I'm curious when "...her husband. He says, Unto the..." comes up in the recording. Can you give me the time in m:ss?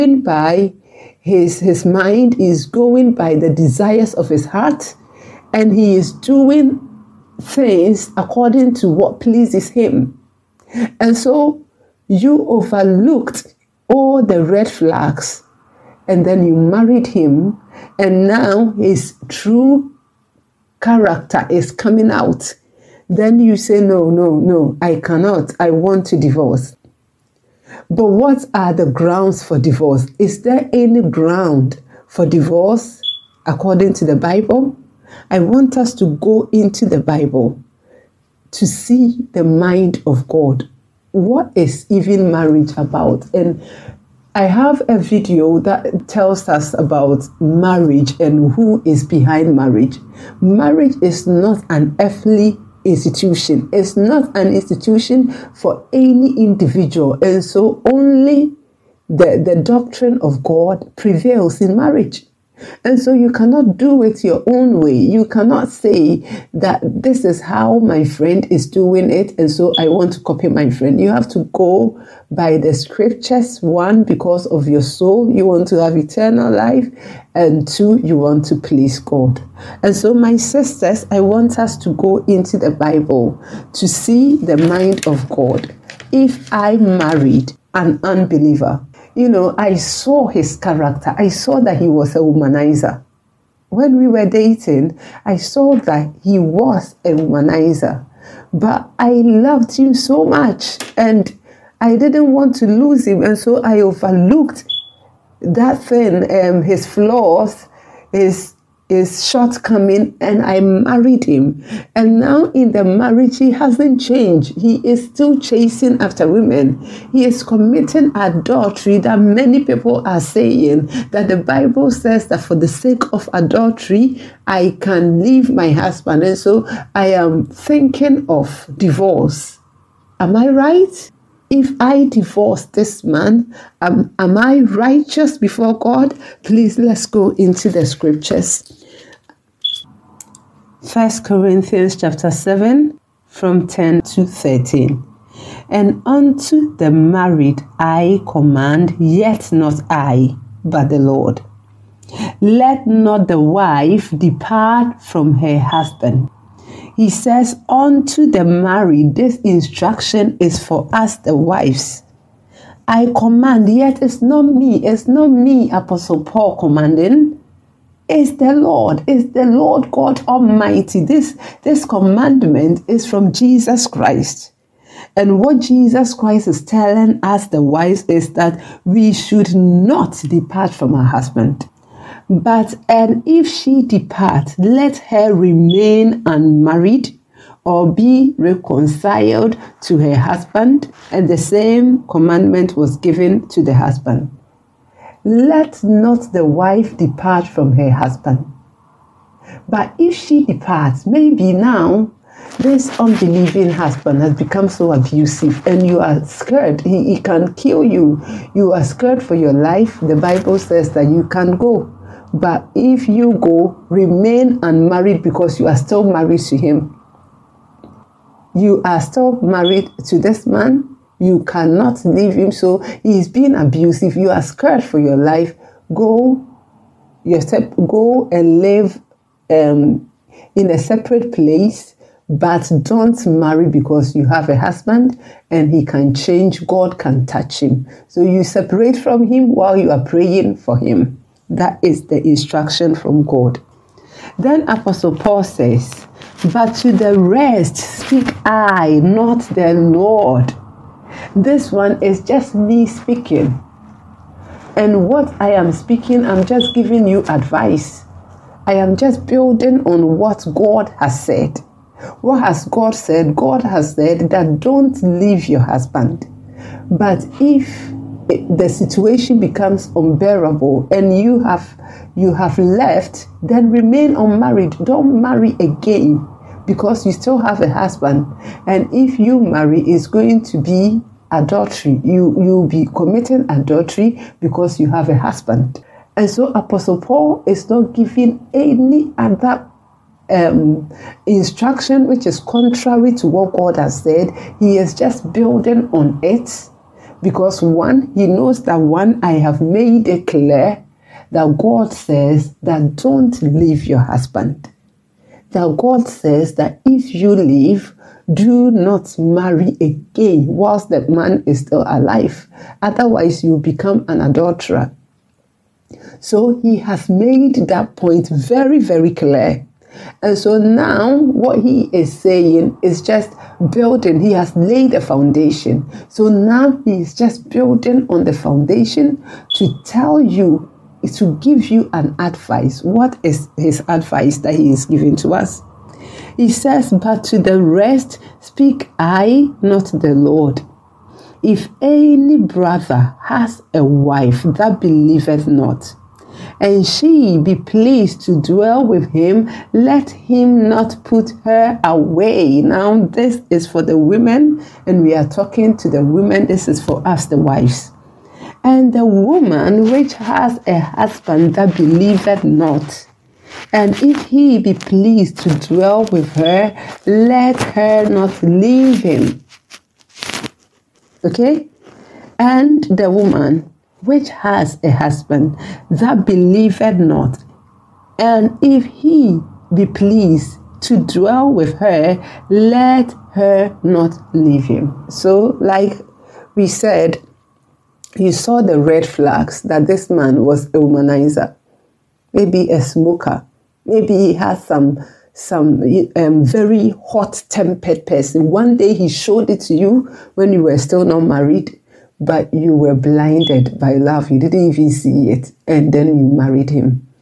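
2:35.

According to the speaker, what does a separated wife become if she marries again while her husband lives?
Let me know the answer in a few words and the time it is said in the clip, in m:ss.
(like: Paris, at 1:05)
an adulterer, at 5:14.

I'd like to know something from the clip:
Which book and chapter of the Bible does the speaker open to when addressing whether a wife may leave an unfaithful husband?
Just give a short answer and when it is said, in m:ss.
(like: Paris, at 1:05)
First Corinthians chapter 7, at 2:20.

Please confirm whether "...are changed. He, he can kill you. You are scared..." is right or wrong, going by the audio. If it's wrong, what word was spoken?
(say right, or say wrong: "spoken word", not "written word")
wrong: "scared", not "changed".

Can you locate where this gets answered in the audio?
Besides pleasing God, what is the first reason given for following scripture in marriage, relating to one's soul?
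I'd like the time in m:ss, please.
1:15.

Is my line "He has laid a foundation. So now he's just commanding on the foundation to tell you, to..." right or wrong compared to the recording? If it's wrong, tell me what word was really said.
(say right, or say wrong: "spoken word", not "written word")
wrong: "building", not "commanding".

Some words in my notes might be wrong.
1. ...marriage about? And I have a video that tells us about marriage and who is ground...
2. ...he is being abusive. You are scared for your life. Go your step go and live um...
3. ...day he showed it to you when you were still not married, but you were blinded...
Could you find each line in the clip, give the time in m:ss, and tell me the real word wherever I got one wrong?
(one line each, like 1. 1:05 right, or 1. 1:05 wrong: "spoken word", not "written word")
1. 0:42 wrong: "behind", not "ground"
2. 3:43 right
3. 6:38 right.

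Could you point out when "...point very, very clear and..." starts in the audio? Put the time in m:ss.
5:17.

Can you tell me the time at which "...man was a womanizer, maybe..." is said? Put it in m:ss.
6:30.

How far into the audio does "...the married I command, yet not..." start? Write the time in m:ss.
2:26.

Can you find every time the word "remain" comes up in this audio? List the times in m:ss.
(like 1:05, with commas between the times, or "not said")
3:05, 3:33, 4:33.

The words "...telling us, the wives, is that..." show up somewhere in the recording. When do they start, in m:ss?
2:56.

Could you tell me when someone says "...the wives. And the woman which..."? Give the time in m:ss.
5:57.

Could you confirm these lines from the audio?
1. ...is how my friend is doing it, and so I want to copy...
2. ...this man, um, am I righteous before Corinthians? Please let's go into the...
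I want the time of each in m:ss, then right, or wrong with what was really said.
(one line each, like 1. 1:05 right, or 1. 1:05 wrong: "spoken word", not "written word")
1. 1:07 right
2. 2:12 wrong: "God", not "Corinthians".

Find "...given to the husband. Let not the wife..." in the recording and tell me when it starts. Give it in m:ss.
3:12.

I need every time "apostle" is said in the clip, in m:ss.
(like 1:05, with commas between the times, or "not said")
2:45, 4:04, 4:46.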